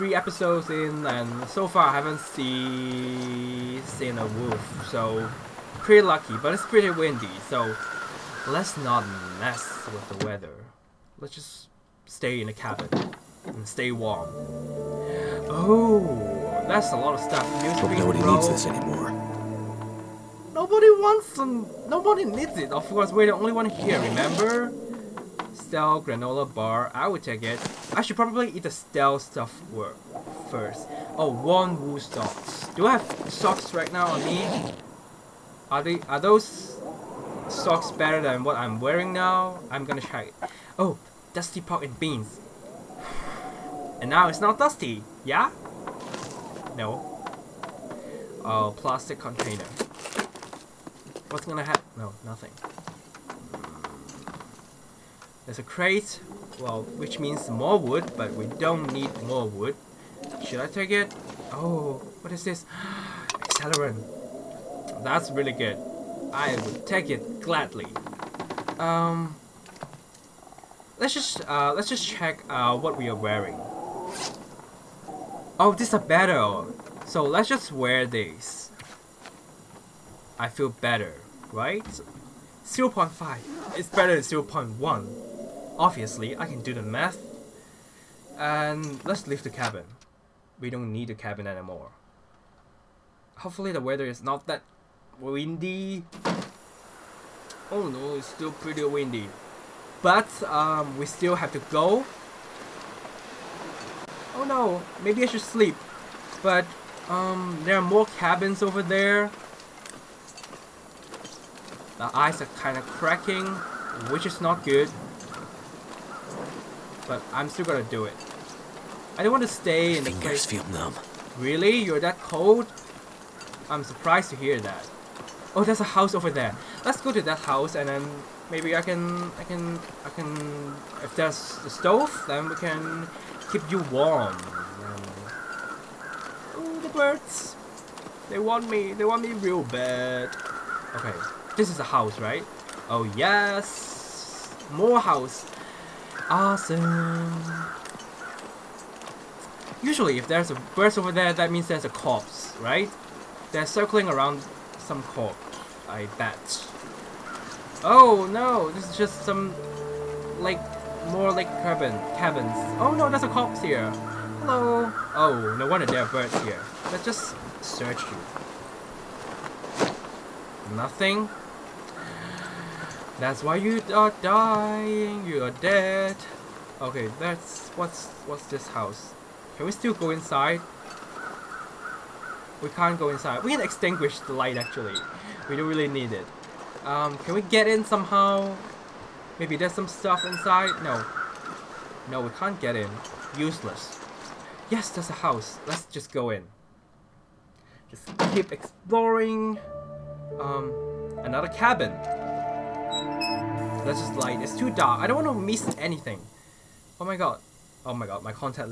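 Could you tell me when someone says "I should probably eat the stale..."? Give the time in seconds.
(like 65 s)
27 s.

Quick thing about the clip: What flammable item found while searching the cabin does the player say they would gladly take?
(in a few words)
Accelerant.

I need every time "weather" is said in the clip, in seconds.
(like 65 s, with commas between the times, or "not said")
10 s, 93 s.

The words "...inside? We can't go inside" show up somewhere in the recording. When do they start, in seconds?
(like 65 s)
180 s.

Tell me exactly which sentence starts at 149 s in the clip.
Usually if there's a bird over there, that means there's a corpse, right?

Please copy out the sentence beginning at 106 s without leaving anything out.
But um, there are more cabins over there.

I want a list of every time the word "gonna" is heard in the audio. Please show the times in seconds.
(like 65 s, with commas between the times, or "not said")
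39 s, 51 s, 117 s.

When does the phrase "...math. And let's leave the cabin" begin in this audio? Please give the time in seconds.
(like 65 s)
86 s.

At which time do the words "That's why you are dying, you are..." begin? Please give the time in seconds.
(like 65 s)
173 s.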